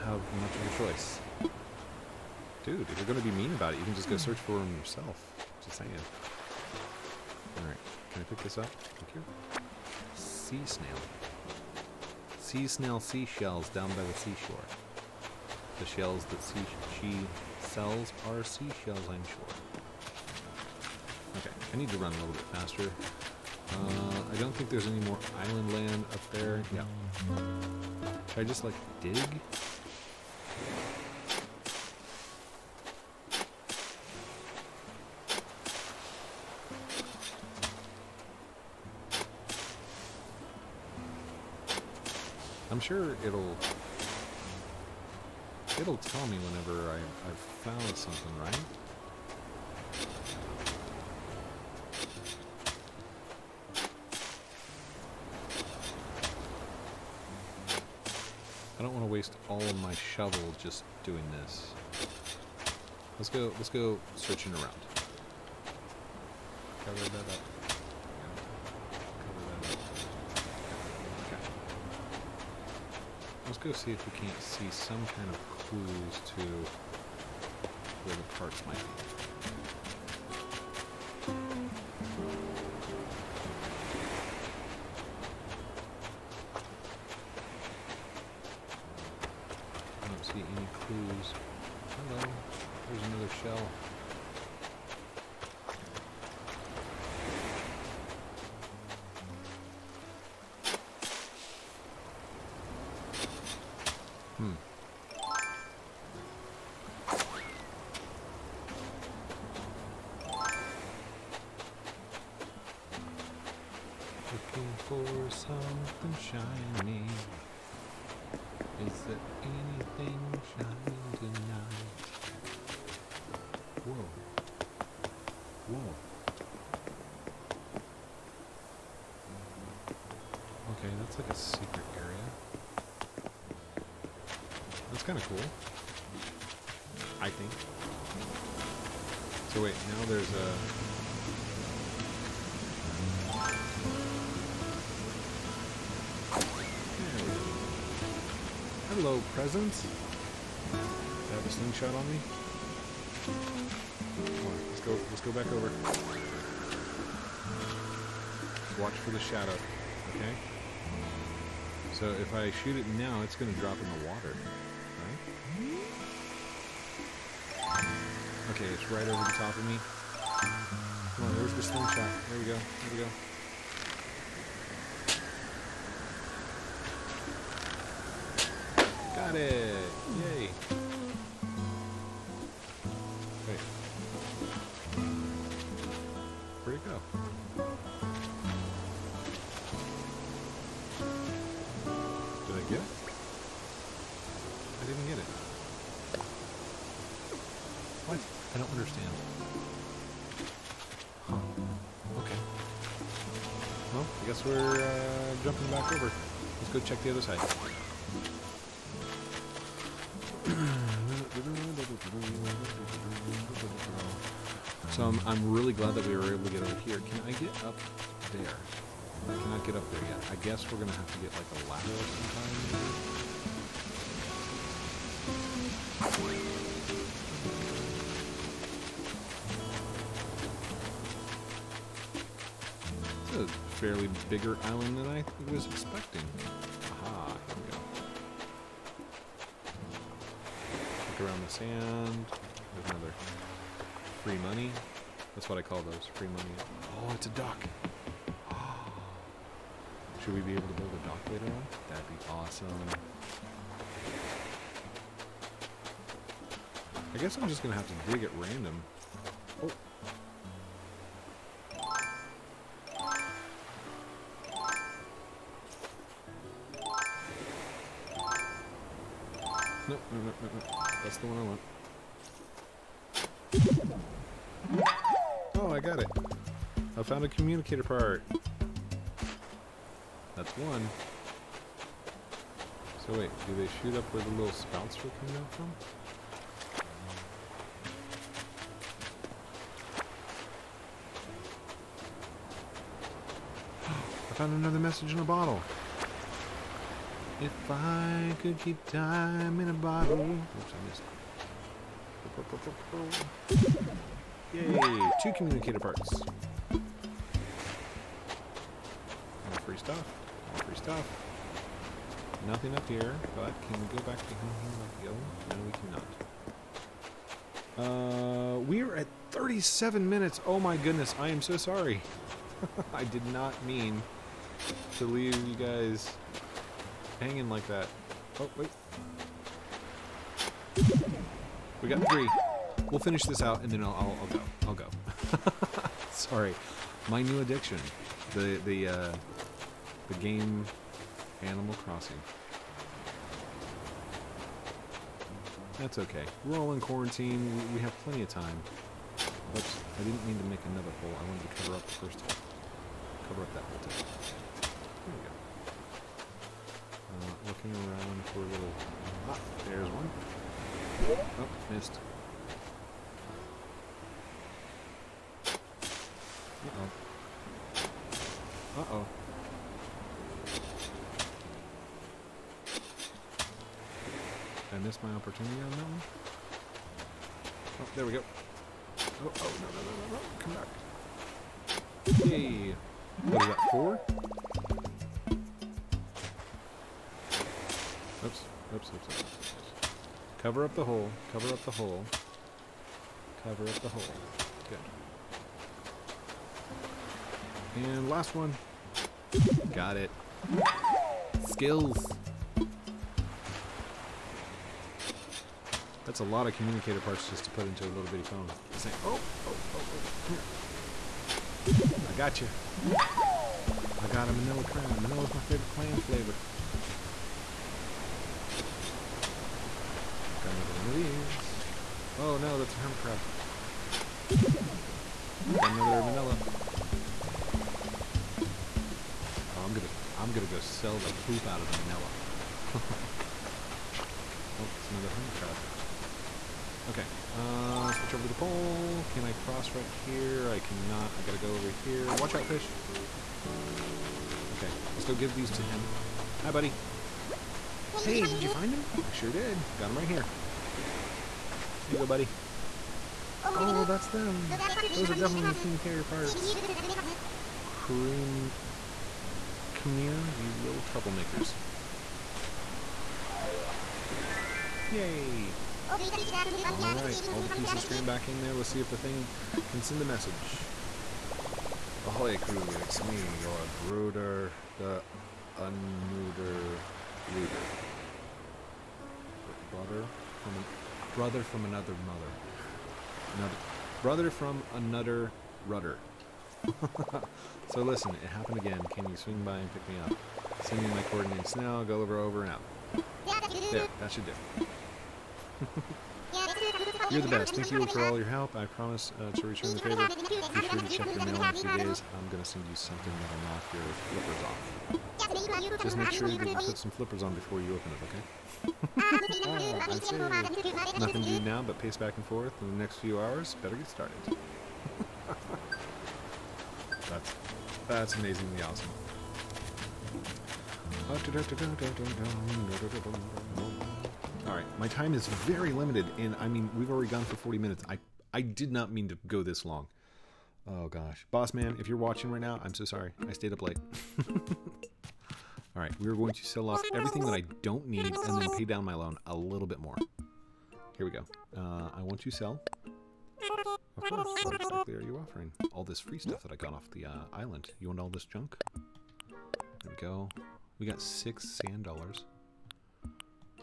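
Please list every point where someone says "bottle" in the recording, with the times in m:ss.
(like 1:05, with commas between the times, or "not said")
4:55, 4:59.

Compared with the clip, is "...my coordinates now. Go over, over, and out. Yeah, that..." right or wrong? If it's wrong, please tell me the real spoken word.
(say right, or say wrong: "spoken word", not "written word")
right.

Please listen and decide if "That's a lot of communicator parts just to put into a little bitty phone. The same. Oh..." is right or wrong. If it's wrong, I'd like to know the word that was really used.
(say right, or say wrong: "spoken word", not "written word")
right.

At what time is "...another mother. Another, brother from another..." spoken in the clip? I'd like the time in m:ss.
8:01.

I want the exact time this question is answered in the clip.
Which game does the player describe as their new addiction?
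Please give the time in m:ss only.
5:41.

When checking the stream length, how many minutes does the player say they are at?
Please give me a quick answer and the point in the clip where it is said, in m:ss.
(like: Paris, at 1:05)
37, at 5:19.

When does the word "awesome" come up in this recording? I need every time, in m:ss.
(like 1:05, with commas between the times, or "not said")
4:12, 8:38.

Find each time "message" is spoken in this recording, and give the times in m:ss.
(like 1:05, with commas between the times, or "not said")
4:54, 7:50.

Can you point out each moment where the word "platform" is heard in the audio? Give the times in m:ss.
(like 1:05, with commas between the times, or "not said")
not said.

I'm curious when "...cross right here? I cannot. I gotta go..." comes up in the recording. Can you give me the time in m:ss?
7:19.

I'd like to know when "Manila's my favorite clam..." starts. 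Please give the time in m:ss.
6:55.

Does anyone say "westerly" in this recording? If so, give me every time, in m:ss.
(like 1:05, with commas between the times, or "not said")
not said.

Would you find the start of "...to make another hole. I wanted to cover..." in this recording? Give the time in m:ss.
5:50.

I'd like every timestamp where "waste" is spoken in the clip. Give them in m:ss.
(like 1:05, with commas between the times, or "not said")
0:59.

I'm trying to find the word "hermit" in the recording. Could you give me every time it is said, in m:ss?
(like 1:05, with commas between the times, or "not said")
7:02, 7:15.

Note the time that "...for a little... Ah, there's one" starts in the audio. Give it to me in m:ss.
5:58.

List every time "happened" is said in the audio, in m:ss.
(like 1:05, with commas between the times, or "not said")
8:08.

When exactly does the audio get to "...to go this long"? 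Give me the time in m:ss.
8:49.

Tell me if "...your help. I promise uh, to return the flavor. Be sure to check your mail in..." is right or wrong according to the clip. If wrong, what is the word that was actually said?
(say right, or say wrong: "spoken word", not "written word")
wrong: "favor", not "flavor".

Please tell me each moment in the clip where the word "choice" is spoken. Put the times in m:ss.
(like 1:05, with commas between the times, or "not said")
0:00.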